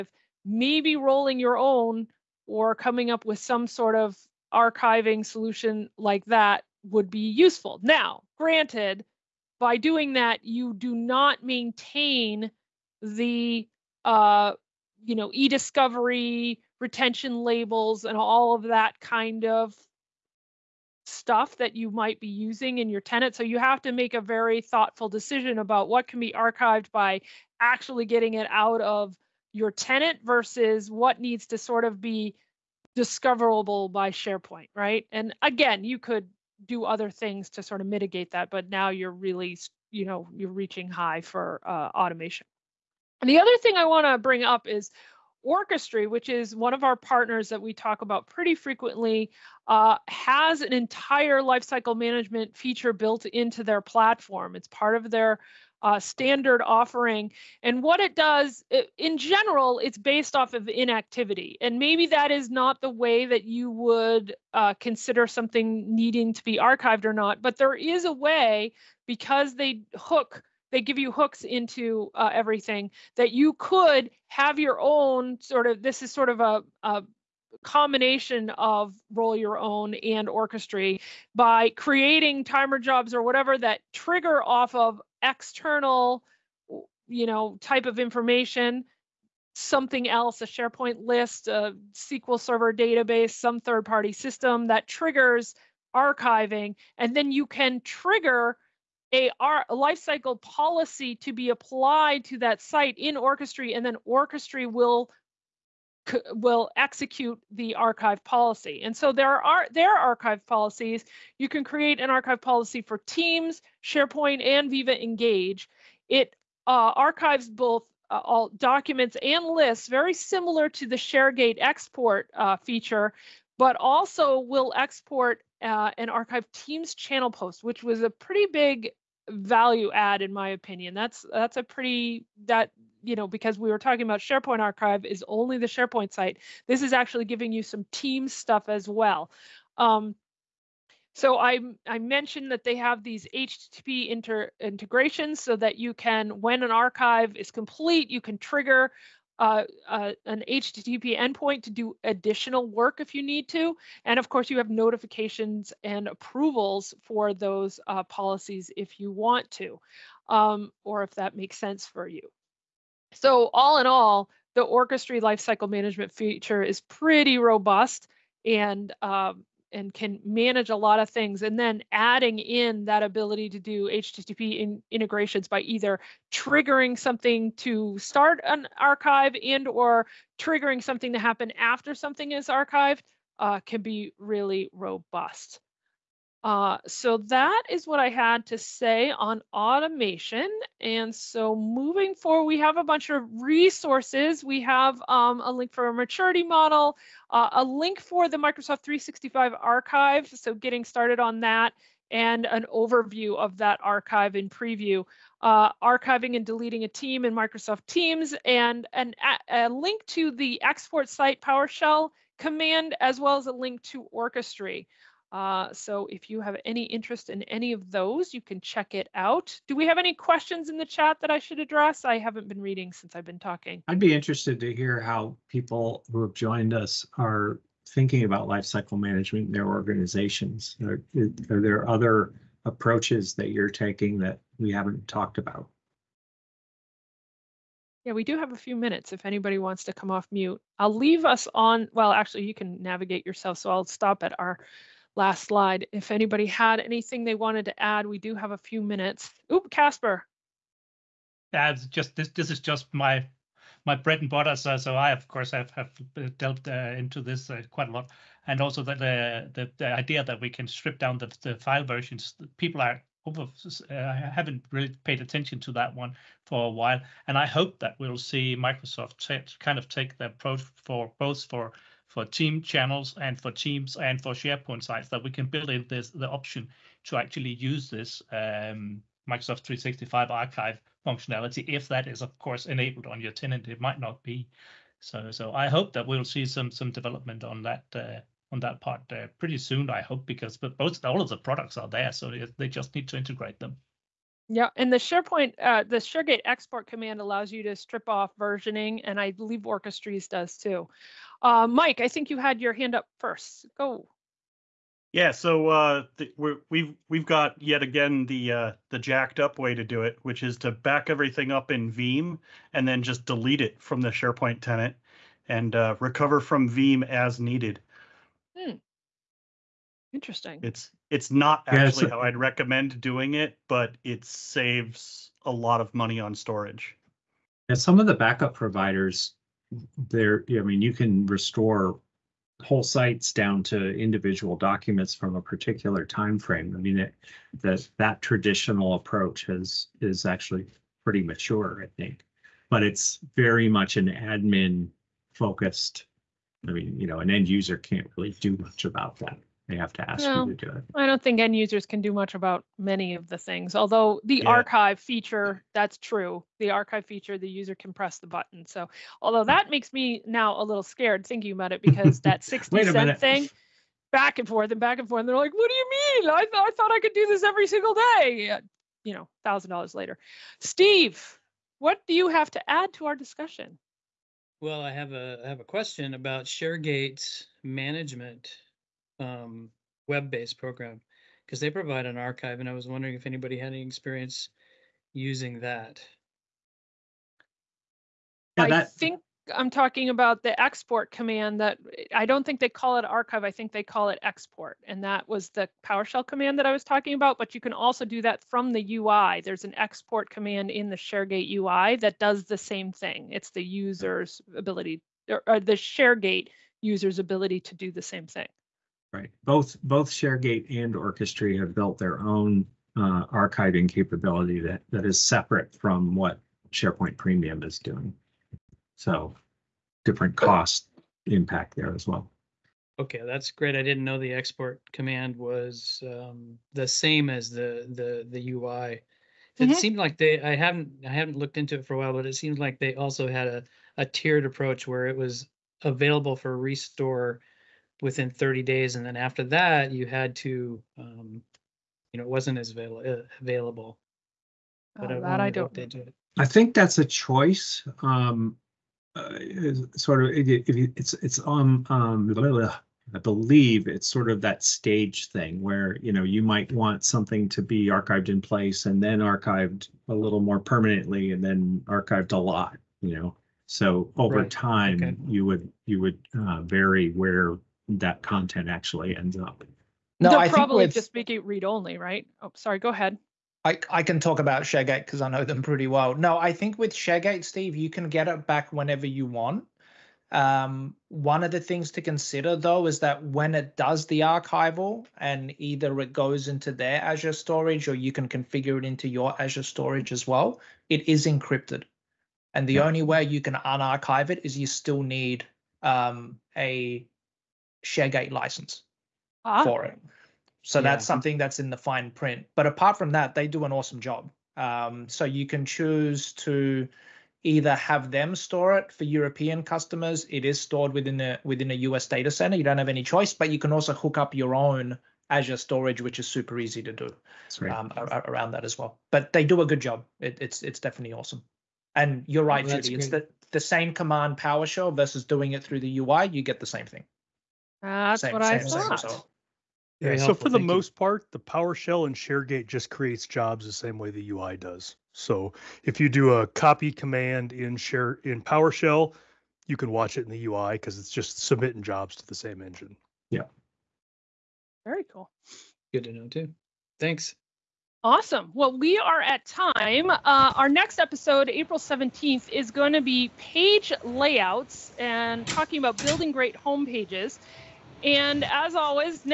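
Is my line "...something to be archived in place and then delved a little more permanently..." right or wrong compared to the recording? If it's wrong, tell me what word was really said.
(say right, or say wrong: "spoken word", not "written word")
wrong: "archived", not "delved".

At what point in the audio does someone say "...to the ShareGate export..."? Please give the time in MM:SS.
02:00.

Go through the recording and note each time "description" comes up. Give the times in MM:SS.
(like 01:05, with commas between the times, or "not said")
not said.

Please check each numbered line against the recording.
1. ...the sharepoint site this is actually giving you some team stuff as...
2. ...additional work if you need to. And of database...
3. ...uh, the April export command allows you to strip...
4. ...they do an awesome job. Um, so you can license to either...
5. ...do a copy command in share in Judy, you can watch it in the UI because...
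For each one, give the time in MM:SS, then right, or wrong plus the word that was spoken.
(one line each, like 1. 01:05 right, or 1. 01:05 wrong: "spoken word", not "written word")
1. 02:15 right
2. 02:32 wrong: "course", not "database"
3. 04:55 wrong: "ShareGate", not "April"
4. 08:23 wrong: "choose", not "license"
5. 08:56 wrong: "PowerShell", not "Judy".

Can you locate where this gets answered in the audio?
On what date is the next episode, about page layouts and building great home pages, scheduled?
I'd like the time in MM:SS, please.
09:11.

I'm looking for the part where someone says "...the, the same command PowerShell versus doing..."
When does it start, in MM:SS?
08:43.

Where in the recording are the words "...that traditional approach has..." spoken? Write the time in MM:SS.
05:37.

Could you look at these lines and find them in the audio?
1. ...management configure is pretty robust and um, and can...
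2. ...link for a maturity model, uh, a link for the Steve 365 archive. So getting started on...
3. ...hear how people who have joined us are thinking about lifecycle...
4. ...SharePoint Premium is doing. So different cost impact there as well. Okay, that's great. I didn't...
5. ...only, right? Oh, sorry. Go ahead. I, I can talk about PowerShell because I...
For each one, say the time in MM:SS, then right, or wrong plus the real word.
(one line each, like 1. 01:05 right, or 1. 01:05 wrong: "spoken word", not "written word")
1. 02:45 wrong: "feature", not "configure"
2. 03:15 wrong: "Microsoft", not "Steve"
3. 03:44 right
4. 06:56 right
5. 07:51 wrong: "ShareGate", not "PowerShell".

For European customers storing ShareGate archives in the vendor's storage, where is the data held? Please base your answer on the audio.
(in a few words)
A US data center.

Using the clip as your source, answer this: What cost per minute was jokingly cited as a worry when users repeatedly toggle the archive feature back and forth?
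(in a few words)
60 cents.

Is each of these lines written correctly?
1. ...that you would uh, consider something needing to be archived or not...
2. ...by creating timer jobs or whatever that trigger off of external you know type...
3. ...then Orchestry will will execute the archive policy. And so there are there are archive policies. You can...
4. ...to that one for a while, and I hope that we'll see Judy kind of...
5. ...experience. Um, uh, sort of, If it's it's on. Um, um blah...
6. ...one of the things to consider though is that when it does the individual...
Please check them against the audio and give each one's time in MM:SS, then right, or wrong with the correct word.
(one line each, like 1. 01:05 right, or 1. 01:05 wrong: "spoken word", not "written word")
1. 01:03 right
2. 01:21 right
3. 01:43 right
4. 04:25 wrong: "Microsoft", not "Judy"
5. 07:27 wrong: "choice", not "experience"
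6. 08:01 wrong: "archival", not "individual".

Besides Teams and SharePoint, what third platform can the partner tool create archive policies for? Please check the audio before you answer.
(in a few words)
Viva Engage.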